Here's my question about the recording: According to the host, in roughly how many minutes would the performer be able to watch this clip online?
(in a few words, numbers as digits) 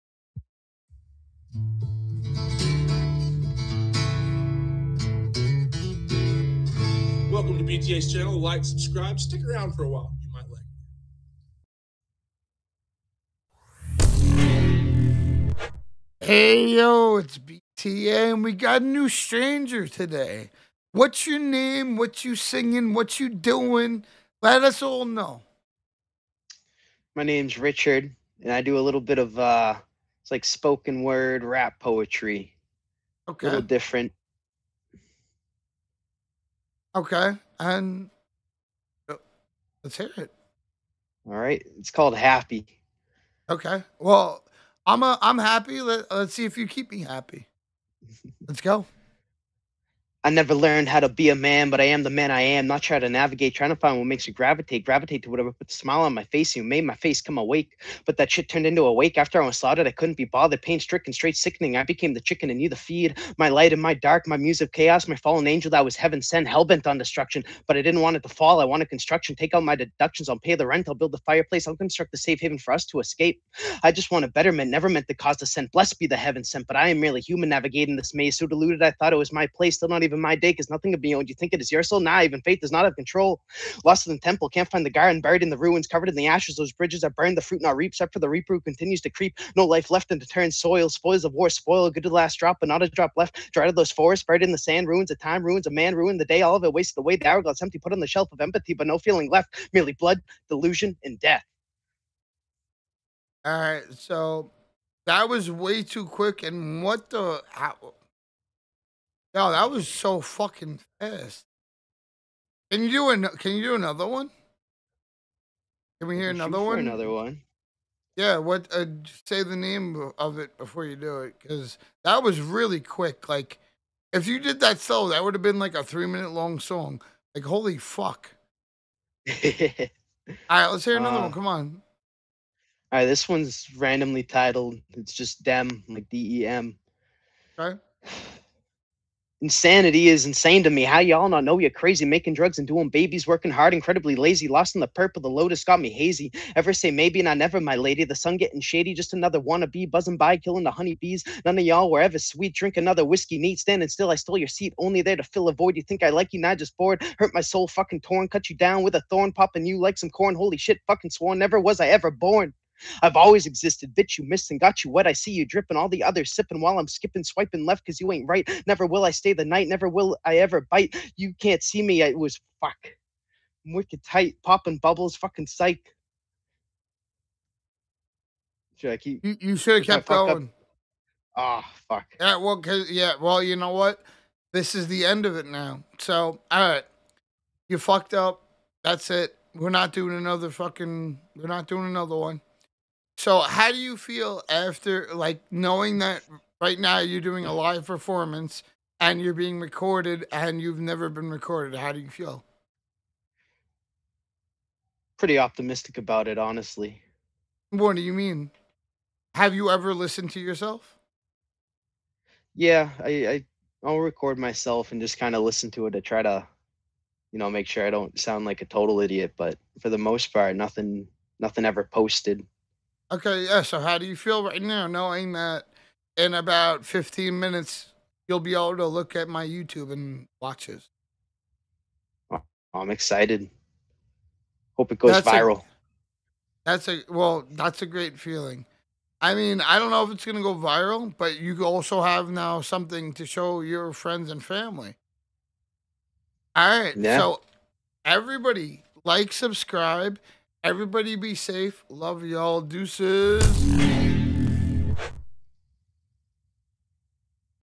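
15.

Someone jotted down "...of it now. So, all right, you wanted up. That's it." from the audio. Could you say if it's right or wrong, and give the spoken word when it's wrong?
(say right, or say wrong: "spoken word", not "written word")
wrong: "fucked", not "wanted".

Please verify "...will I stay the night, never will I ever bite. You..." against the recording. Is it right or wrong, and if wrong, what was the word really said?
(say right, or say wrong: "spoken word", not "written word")
right.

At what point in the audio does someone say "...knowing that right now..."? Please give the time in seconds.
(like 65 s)
195 s.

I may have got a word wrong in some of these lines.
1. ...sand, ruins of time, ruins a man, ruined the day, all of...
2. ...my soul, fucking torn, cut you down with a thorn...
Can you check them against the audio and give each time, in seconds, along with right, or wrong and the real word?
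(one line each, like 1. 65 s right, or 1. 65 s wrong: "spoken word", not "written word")
1. 94 s right
2. 157 s right.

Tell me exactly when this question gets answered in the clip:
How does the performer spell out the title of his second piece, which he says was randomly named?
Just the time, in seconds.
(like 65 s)
136 s.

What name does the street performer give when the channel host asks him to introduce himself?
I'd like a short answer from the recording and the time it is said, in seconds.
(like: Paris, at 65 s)
Richard, at 27 s.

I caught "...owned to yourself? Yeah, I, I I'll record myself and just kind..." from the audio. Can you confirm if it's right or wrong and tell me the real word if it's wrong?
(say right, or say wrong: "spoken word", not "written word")
wrong: "listened", not "owned".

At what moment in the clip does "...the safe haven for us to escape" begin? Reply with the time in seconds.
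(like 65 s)
72 s.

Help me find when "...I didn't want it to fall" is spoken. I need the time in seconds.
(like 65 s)
67 s.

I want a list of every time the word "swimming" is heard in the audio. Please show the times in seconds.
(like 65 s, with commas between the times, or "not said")
not said.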